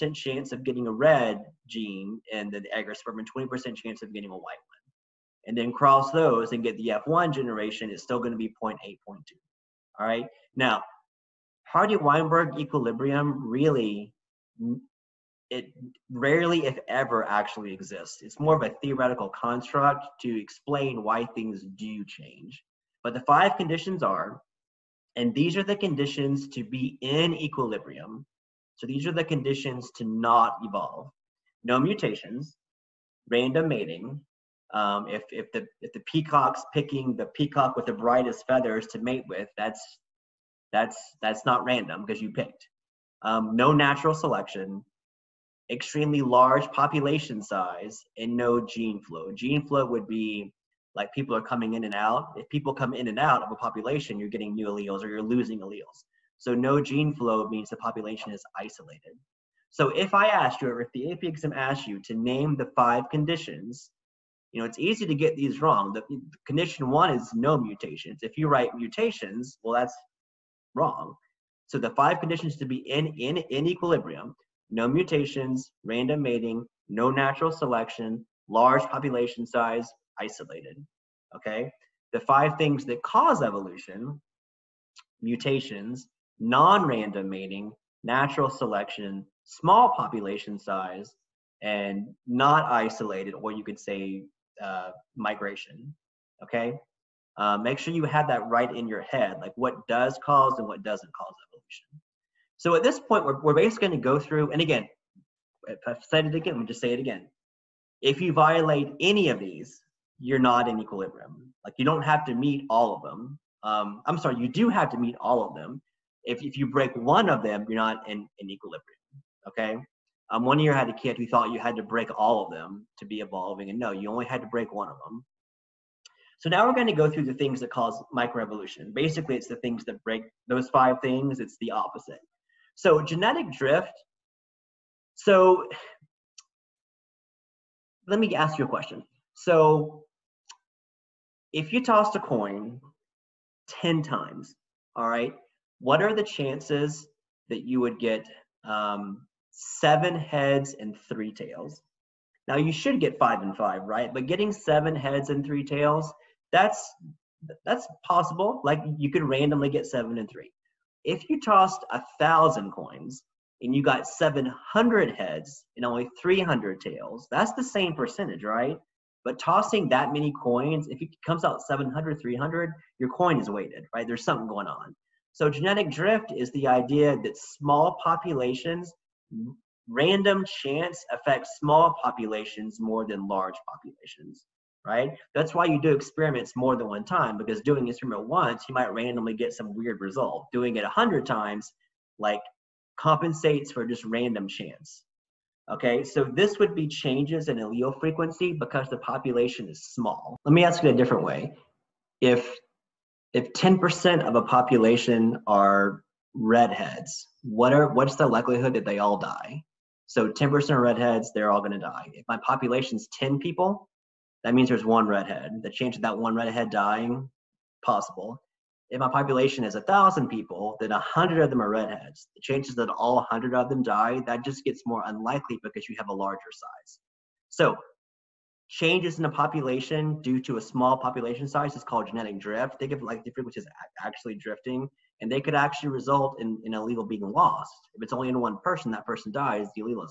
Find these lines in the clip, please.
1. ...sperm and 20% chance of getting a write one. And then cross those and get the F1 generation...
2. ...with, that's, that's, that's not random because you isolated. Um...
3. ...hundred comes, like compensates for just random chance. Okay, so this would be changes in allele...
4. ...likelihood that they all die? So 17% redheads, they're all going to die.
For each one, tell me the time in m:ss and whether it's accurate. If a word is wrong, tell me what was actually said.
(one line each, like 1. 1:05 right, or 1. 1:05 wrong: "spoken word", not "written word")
1. 0:02 wrong: "white", not "write"
2. 0:39 wrong: "picked", not "isolated"
3. 3:10 wrong: "times", not "comes"
4. 3:28 wrong: "10", not "17".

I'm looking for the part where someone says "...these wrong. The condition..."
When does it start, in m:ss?
1:05.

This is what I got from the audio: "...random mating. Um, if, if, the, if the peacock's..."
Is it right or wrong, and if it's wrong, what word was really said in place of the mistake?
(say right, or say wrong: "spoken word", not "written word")
right.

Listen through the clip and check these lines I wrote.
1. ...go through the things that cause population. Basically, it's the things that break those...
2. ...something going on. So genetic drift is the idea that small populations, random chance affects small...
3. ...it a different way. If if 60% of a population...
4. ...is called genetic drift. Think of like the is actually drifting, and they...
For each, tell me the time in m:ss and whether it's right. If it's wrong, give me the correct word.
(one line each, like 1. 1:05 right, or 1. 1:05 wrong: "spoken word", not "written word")
1. 2:06 wrong: "microevolution", not "population"
2. 2:54 right
3. 3:20 wrong: "10", not "60"
4. 3:51 right.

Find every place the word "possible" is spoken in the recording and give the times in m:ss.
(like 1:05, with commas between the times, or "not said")
2:38, 3:37.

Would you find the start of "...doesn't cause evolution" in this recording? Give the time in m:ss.
1:40.